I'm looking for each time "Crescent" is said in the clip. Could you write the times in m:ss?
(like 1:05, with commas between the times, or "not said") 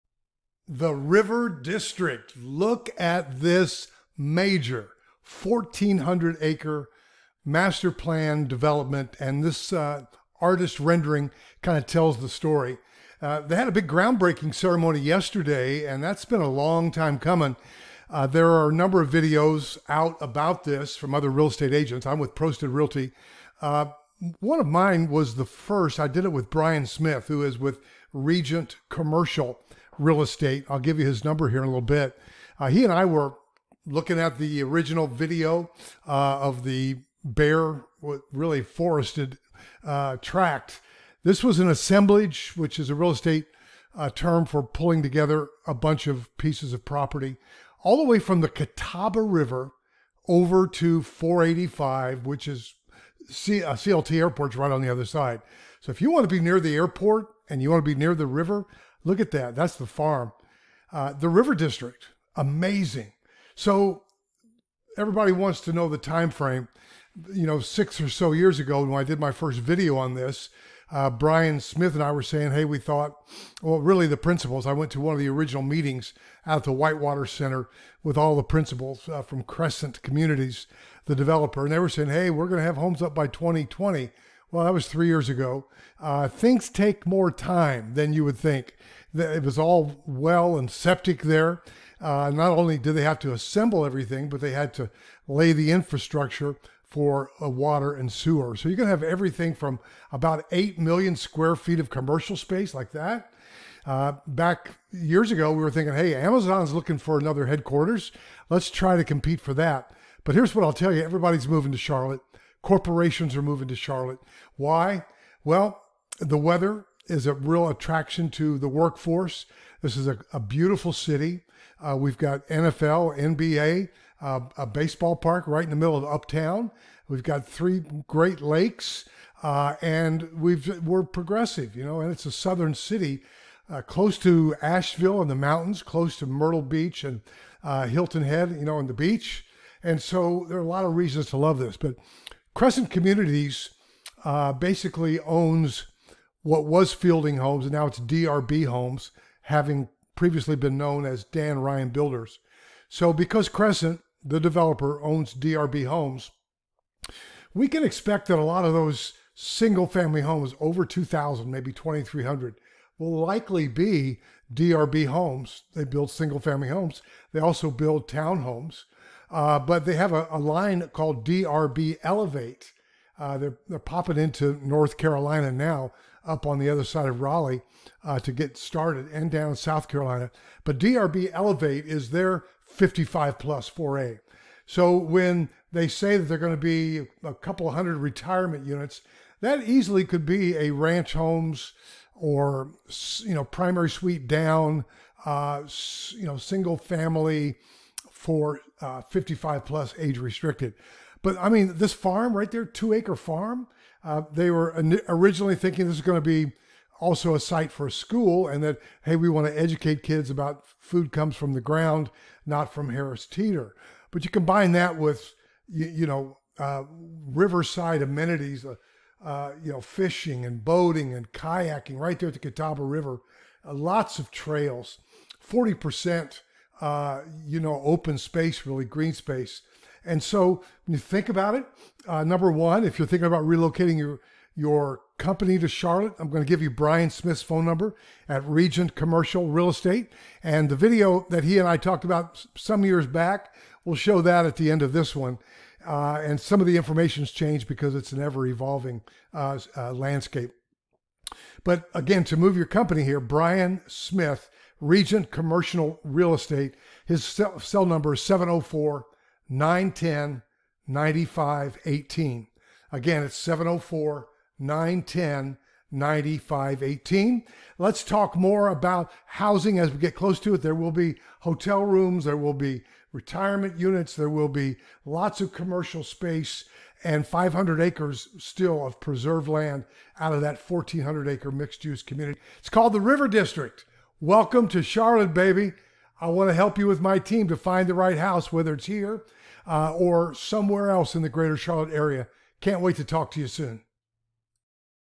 1:19, 2:22, 2:33.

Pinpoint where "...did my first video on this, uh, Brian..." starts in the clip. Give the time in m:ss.
1:09.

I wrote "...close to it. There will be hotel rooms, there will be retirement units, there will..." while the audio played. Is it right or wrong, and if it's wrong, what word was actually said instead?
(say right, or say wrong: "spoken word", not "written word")
right.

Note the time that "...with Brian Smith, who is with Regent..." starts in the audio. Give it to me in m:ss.
0:26.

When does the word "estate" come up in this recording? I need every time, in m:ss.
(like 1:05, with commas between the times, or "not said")
0:21, 0:30, 0:43, 3:59, 4:16.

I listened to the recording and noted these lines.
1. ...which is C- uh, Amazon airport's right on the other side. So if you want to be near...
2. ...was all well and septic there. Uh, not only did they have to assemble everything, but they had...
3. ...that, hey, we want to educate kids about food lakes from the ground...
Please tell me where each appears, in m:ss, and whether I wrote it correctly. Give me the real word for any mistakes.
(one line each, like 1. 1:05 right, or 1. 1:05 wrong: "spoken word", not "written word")
1. 0:52 wrong: "CLT", not "Amazon"
2. 1:29 right
3. 3:28 wrong: "comes", not "lakes".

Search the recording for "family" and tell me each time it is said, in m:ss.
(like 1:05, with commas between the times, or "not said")
2:39, 2:46, 3:16.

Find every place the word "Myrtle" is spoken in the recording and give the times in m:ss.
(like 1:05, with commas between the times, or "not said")
2:16.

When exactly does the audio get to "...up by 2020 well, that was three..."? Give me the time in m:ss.
1:23.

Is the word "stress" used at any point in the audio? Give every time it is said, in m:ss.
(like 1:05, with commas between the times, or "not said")
not said.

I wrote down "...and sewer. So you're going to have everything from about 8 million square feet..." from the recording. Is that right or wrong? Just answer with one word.
right.